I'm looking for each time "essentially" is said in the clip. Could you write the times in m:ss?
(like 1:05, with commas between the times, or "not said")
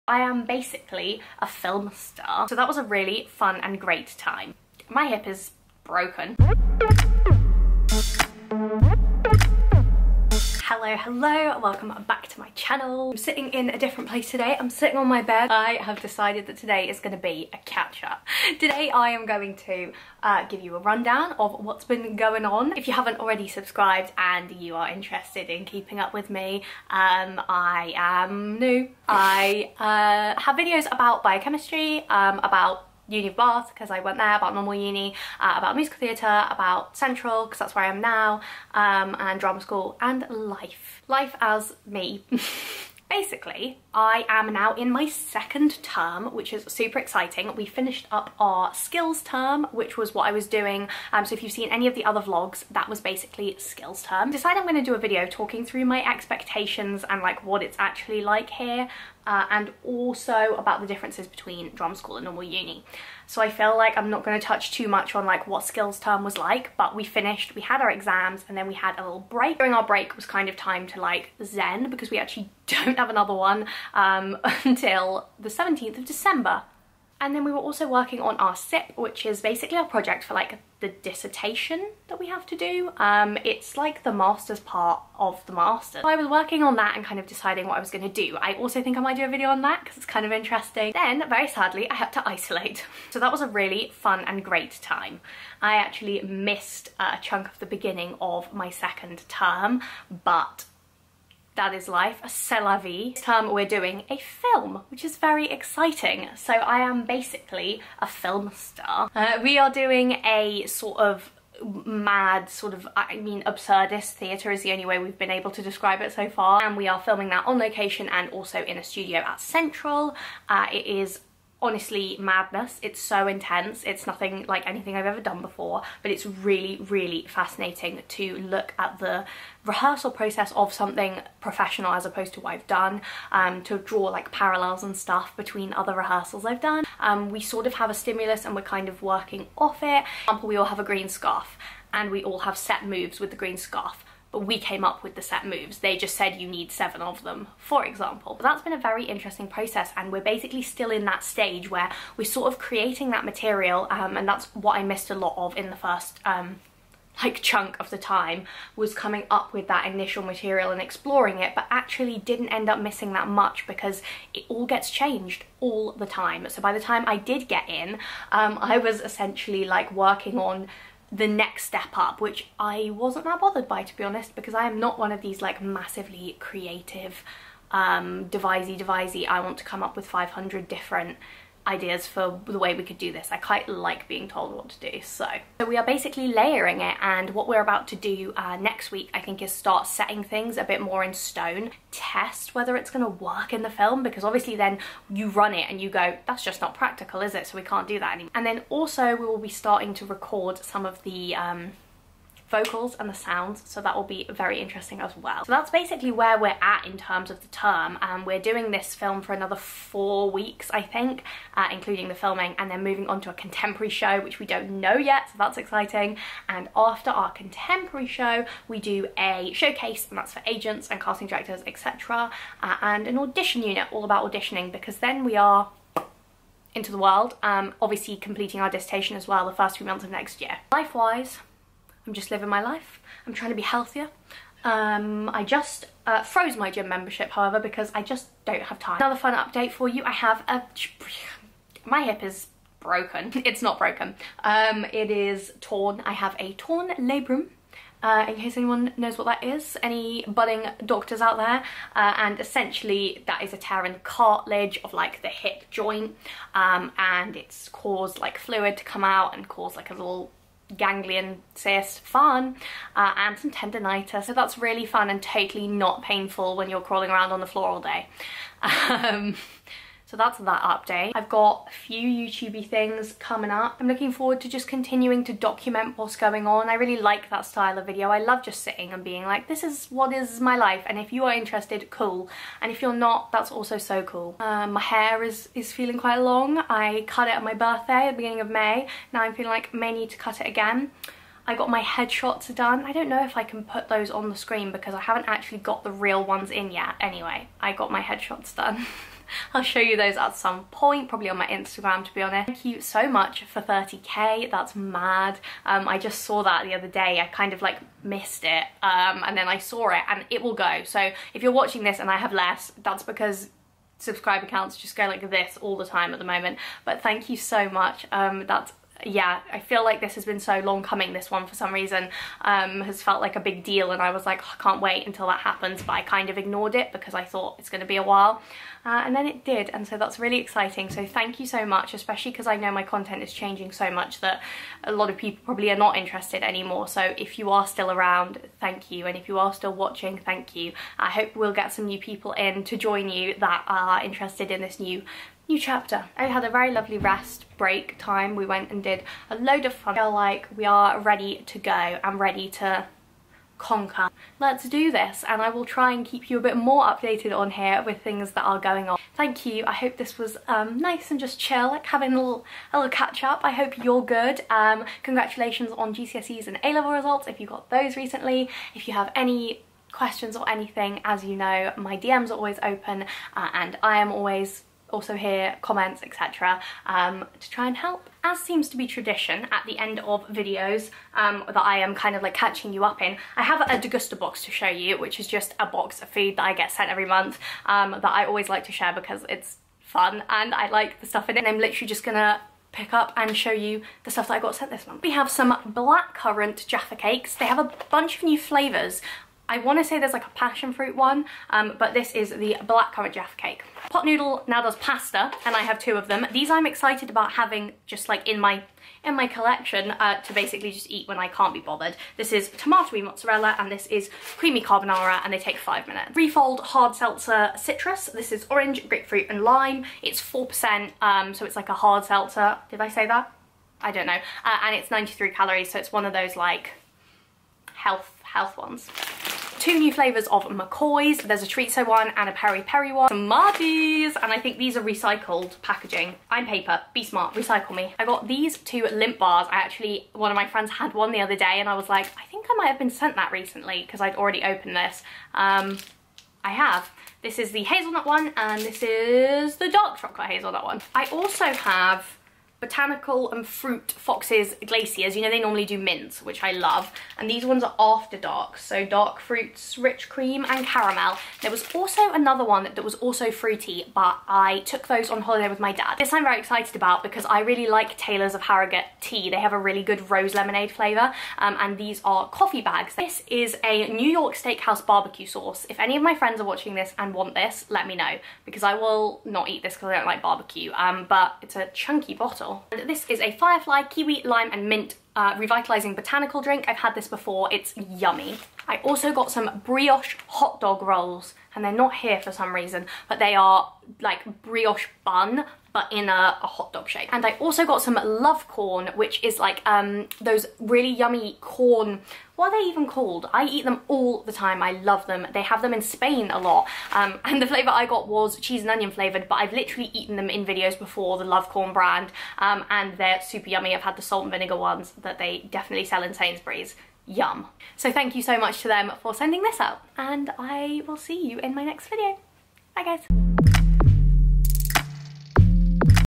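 2:49, 4:12.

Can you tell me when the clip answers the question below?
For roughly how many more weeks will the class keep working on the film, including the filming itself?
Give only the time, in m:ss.
3:29.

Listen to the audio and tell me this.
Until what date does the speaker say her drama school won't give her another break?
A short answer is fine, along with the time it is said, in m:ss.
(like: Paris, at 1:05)
17th of December, at 1:15.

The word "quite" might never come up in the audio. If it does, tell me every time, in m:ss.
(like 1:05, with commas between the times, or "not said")
3:03, 4:45.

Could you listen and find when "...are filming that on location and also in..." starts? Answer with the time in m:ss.
1:56.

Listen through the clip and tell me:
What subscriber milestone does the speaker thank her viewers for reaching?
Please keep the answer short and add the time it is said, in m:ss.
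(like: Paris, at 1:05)
30k, at 5:03.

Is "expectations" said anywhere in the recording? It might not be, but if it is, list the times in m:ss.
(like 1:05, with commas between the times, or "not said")
0:56.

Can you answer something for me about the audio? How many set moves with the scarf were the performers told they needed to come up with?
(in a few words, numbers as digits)
7.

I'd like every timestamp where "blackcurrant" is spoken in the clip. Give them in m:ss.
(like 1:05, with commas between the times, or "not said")
6:35, 6:42.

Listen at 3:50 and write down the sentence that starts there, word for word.
Life-wise, I'm just living my life.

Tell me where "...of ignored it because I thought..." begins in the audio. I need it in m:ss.
5:26.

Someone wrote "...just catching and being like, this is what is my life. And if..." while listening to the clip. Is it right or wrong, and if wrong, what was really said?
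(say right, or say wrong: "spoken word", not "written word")
wrong: "sitting", not "catching".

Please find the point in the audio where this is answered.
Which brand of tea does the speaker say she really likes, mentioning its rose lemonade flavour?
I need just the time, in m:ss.
7:47.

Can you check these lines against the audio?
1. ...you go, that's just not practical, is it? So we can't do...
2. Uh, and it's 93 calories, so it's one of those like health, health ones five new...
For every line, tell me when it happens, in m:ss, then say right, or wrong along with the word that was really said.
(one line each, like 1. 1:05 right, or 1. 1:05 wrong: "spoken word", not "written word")
1. 3:15 right
2. 7:04 wrong: "two", not "five".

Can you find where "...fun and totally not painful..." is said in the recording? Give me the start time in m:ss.
4:24.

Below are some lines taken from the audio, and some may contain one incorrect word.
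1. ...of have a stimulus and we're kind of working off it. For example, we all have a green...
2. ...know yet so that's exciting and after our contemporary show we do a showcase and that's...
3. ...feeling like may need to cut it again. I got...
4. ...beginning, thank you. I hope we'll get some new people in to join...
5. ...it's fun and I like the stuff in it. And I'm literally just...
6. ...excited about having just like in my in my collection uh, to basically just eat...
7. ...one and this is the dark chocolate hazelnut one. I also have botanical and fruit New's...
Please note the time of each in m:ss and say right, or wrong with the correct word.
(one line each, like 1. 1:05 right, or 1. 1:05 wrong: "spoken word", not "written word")
1. 2:17 right
2. 3:34 right
3. 4:49 right
4. 5:39 wrong: "watching", not "beginning"
5. 6:29 right
6. 6:46 right
7. 7:28 wrong: "Fox", not "New".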